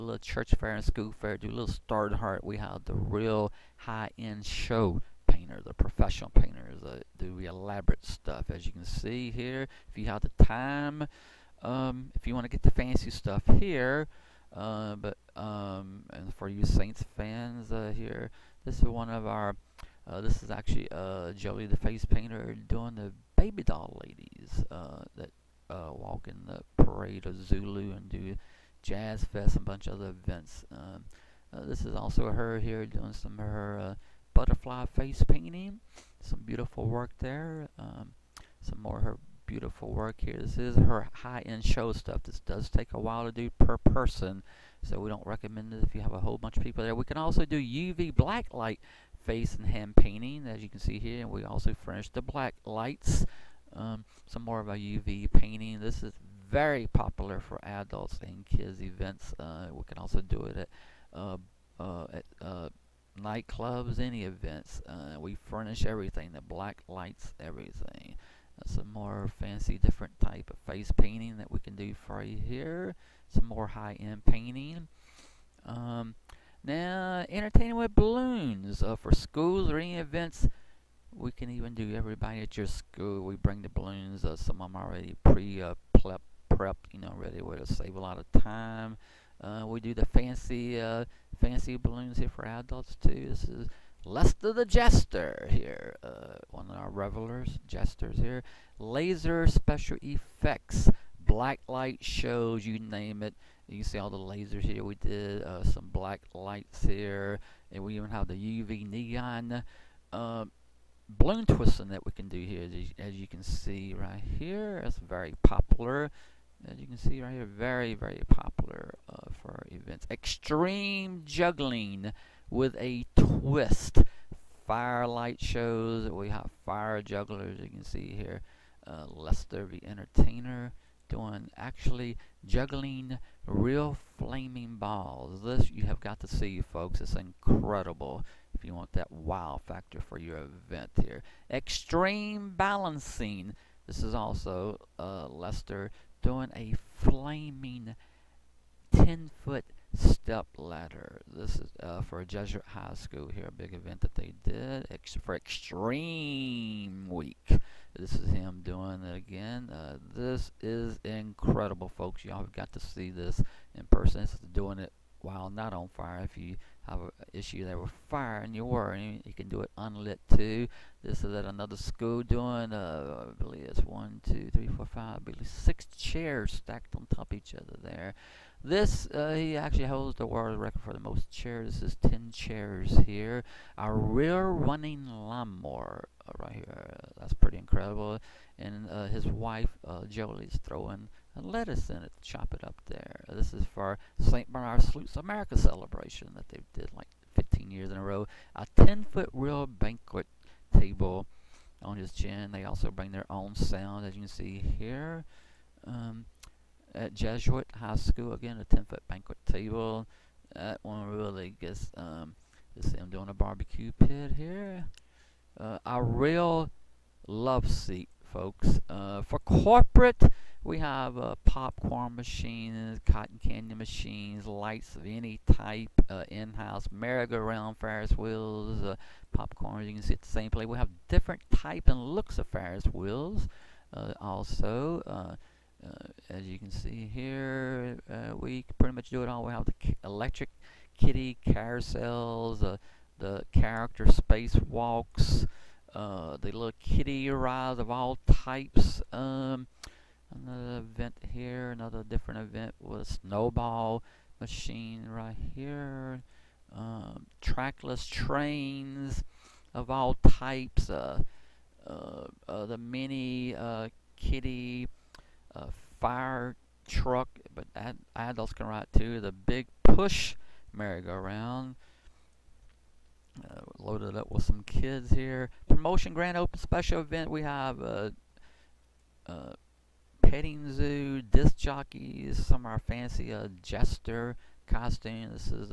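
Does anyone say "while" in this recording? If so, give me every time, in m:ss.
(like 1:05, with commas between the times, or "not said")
0:42, 2:45.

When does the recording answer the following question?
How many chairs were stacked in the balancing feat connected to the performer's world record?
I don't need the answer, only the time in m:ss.
3:02.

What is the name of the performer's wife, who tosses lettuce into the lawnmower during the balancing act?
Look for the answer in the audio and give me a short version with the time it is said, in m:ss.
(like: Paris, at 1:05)
Jolie, at 3:10.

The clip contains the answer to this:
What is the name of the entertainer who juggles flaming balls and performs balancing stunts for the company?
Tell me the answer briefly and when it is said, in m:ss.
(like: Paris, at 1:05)
Lester the Jester, at 1:34.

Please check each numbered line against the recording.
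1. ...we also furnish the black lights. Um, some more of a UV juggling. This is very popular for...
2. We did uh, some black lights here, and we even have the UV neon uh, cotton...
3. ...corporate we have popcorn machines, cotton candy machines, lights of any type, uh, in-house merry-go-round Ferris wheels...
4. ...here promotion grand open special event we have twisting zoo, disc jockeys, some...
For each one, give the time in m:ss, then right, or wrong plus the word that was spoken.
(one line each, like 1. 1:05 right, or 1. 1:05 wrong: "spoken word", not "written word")
1. 0:51 wrong: "painting", not "juggling"
2. 1:44 wrong: "balloon", not "cotton"
3. 3:39 right
4. 4:35 wrong: "petting", not "twisting".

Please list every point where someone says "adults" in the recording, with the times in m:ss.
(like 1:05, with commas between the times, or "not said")
0:57, 1:32, 4:28.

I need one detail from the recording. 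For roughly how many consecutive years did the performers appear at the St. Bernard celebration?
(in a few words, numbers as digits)
15.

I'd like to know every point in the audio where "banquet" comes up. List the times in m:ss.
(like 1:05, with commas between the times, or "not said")
3:19, 3:29.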